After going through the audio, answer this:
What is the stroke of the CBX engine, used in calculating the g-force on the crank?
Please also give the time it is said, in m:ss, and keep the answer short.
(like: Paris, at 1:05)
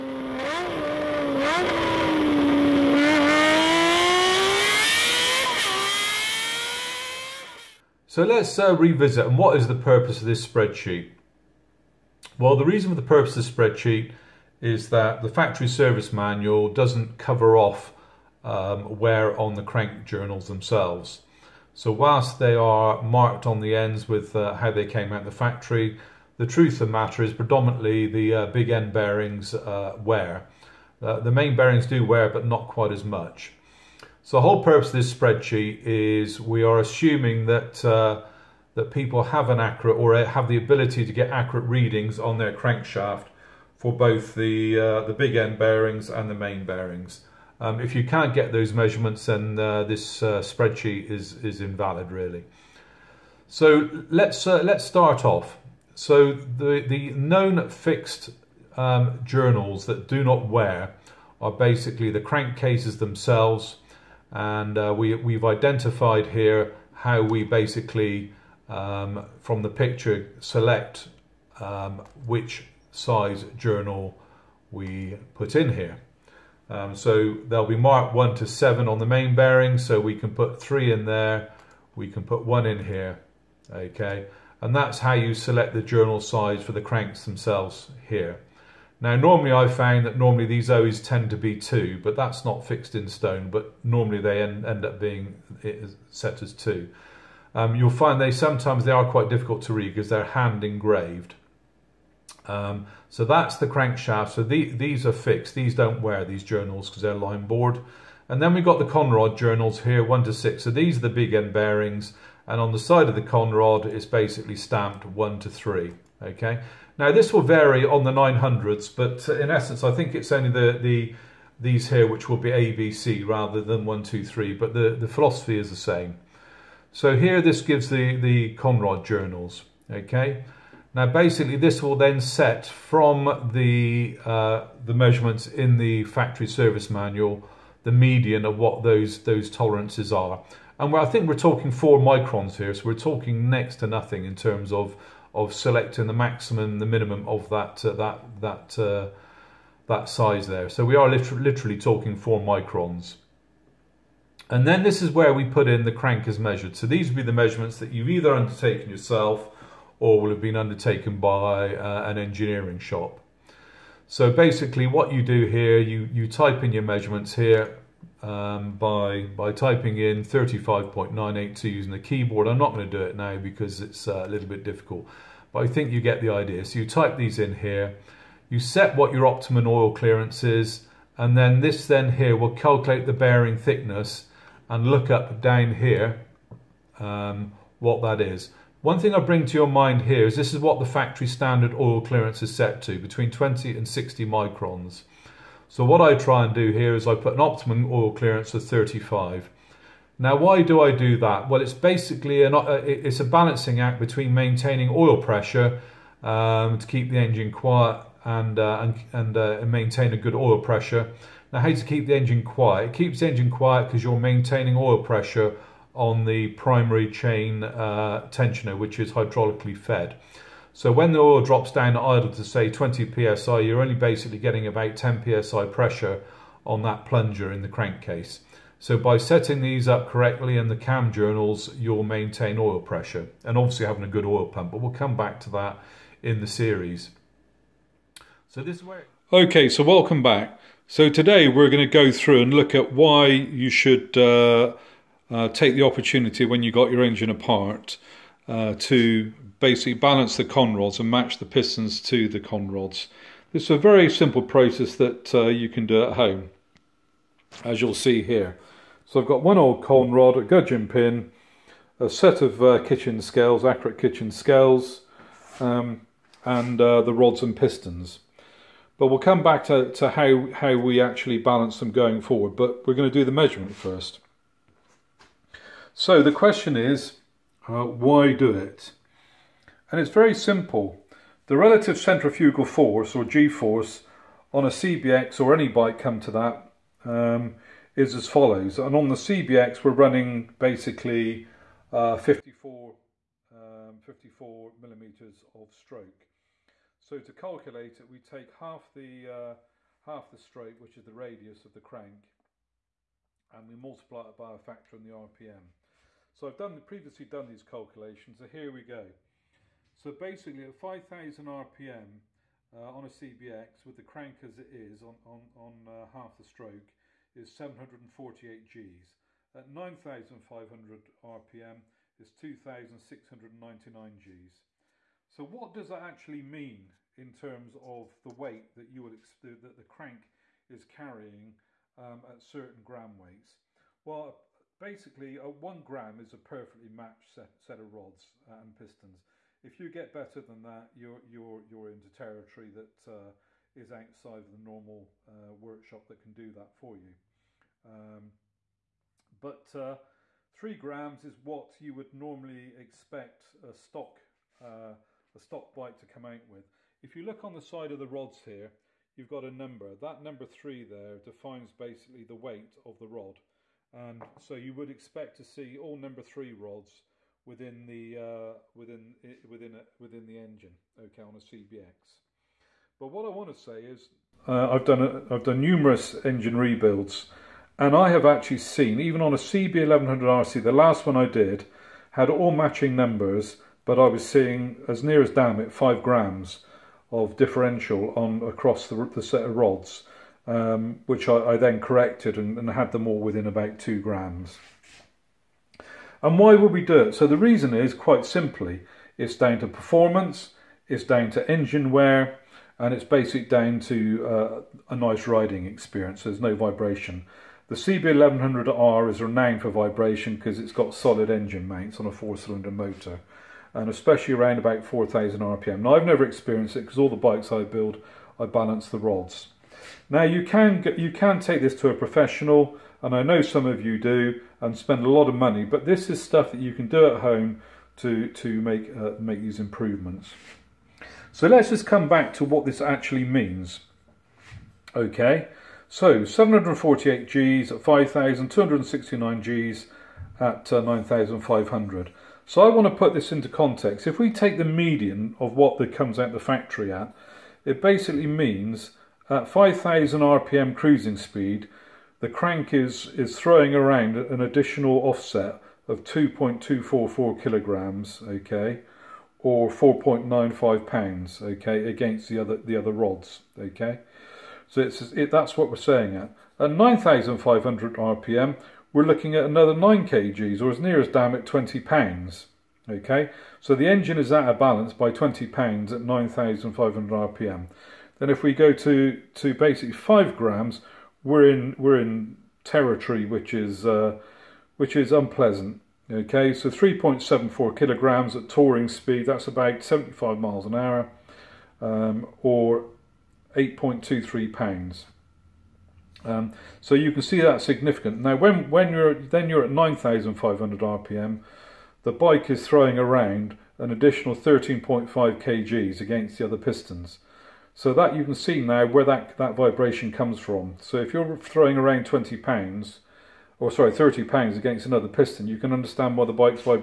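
54 millimeters, at 4:54.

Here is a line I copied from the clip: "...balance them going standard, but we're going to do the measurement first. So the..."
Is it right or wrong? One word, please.
wrong.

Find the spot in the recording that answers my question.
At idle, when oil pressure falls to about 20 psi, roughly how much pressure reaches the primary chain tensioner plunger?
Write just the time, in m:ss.
3:44.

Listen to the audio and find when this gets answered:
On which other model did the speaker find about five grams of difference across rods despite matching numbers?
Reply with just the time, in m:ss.
6:19.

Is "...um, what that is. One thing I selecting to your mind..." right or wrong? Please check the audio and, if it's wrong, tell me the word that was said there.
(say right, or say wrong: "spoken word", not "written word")
wrong: "bring", not "selecting".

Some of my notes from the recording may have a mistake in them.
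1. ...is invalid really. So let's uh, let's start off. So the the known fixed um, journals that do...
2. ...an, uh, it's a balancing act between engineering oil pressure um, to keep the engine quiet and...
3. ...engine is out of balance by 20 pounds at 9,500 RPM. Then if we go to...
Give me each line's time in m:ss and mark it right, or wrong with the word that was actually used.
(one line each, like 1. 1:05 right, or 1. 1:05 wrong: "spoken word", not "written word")
1. 0:51 right
2. 3:22 wrong: "maintaining", not "engineering"
3. 7:53 right.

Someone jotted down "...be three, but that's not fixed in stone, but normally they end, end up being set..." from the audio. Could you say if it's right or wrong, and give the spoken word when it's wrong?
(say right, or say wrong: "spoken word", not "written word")
wrong: "two", not "three".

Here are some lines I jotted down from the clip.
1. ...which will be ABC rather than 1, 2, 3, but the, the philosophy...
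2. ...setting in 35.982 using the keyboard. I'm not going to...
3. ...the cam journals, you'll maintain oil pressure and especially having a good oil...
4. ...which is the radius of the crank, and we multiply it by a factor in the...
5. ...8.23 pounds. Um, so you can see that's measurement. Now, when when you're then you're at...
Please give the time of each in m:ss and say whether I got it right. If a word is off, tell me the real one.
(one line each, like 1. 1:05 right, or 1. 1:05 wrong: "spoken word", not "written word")
1. 2:02 right
2. 2:49 wrong: "typing", not "setting"
3. 3:50 wrong: "obviously", not "especially"
4. 5:00 right
5. 8:13 wrong: "significant", not "measurement".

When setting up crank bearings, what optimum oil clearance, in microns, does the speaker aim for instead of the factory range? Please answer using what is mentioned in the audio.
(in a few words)
35.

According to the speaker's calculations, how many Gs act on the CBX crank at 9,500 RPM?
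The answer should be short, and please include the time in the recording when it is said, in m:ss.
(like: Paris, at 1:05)
2,699, at 5:22.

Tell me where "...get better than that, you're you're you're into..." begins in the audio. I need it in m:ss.
5:39.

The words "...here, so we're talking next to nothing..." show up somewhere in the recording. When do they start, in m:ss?
2:22.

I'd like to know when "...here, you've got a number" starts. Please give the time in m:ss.
5:58.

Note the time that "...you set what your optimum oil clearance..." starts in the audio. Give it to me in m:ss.
2:58.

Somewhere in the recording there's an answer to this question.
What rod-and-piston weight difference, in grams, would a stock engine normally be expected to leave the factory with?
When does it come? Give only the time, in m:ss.
5:50.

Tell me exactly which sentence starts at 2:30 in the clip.
So we are literally talking four microns.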